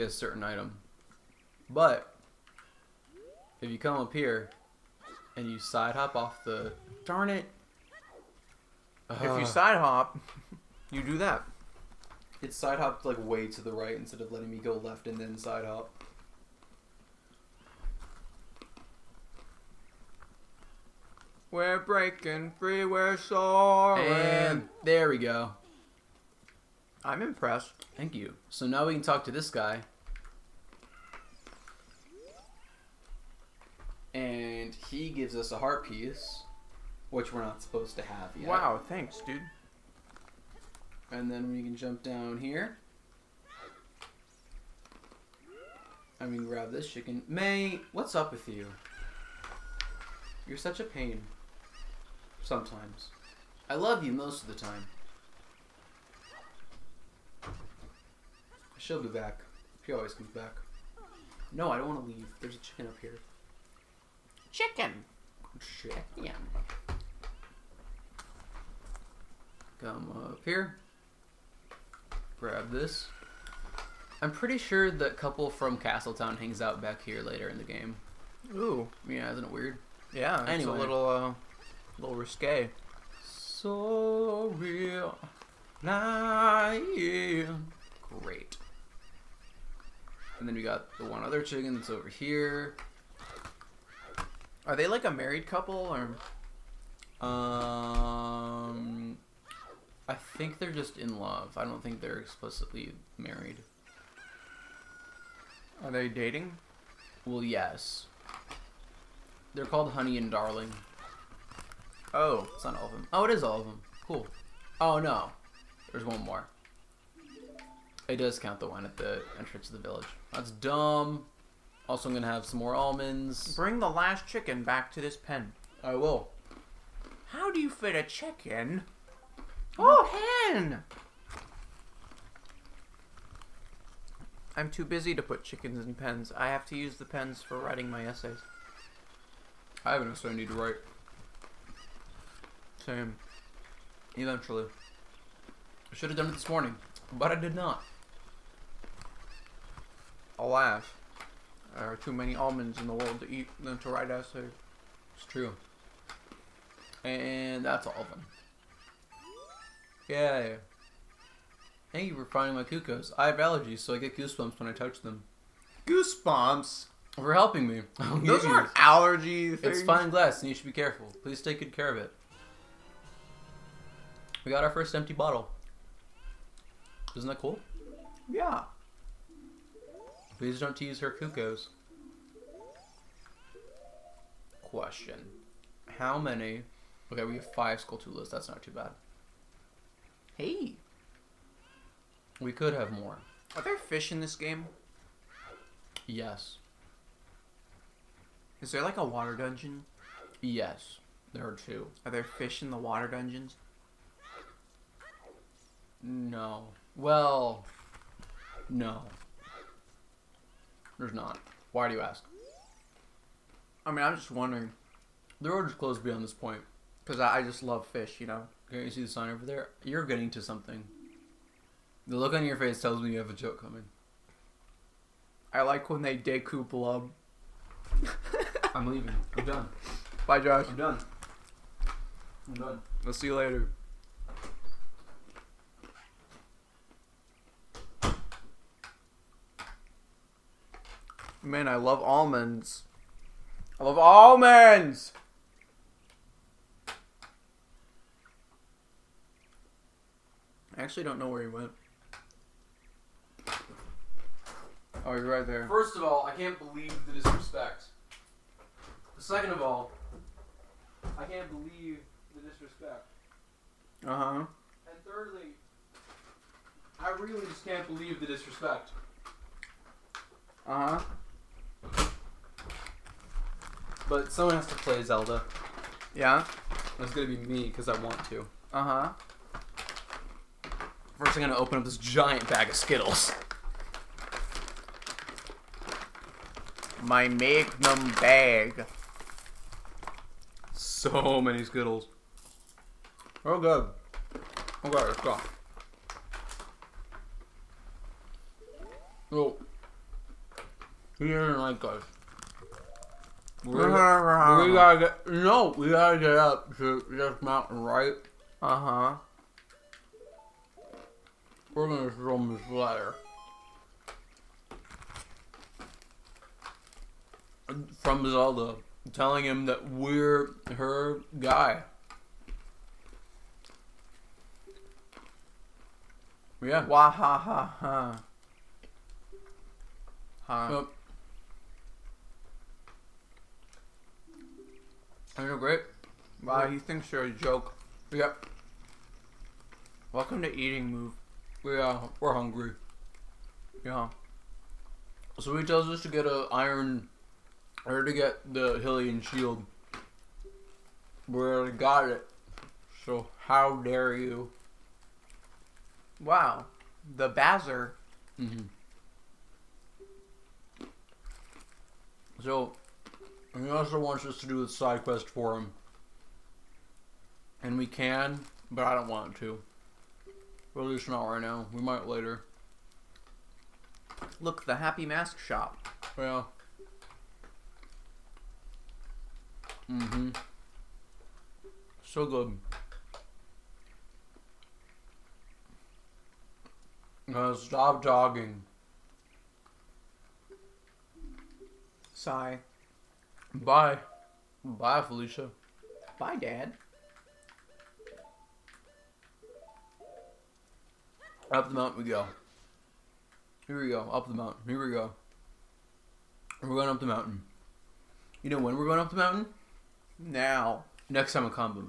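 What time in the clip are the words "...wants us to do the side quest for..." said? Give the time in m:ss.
6:03.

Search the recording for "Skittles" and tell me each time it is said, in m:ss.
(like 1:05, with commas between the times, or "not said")
4:42, 4:51.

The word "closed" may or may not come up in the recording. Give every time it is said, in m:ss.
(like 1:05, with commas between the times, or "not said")
3:35.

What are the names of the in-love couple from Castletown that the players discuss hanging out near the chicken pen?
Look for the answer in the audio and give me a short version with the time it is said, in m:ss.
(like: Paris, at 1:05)
Honey and Darling, at 1:49.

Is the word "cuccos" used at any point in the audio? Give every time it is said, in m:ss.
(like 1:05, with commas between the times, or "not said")
2:42, 3:01.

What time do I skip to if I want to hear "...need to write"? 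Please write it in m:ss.
2:20.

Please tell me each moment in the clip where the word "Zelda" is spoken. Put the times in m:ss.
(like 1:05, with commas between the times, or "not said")
4:35, 5:18.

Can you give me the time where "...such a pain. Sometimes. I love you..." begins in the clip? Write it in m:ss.
0:50.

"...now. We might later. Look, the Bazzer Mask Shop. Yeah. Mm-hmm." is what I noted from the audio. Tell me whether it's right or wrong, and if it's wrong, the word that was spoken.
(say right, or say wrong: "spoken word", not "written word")
wrong: "Happy", not "Bazzer".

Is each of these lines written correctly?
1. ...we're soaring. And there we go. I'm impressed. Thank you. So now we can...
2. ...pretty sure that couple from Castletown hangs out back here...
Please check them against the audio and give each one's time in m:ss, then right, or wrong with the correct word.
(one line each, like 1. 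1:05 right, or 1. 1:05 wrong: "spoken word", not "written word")
1. 0:22 right
2. 1:14 right.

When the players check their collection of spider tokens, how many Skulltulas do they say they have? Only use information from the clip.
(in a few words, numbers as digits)
5.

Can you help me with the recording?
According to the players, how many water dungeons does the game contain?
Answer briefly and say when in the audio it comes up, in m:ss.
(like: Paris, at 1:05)
2, at 3:21.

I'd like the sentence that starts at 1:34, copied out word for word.
Are they like a married couple or um I think they're just in love.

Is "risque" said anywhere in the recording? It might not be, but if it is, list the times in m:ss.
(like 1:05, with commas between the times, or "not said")
1:22.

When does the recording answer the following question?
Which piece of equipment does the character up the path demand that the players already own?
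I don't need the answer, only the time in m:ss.
5:48.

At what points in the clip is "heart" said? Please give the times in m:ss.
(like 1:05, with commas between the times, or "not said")
0:35.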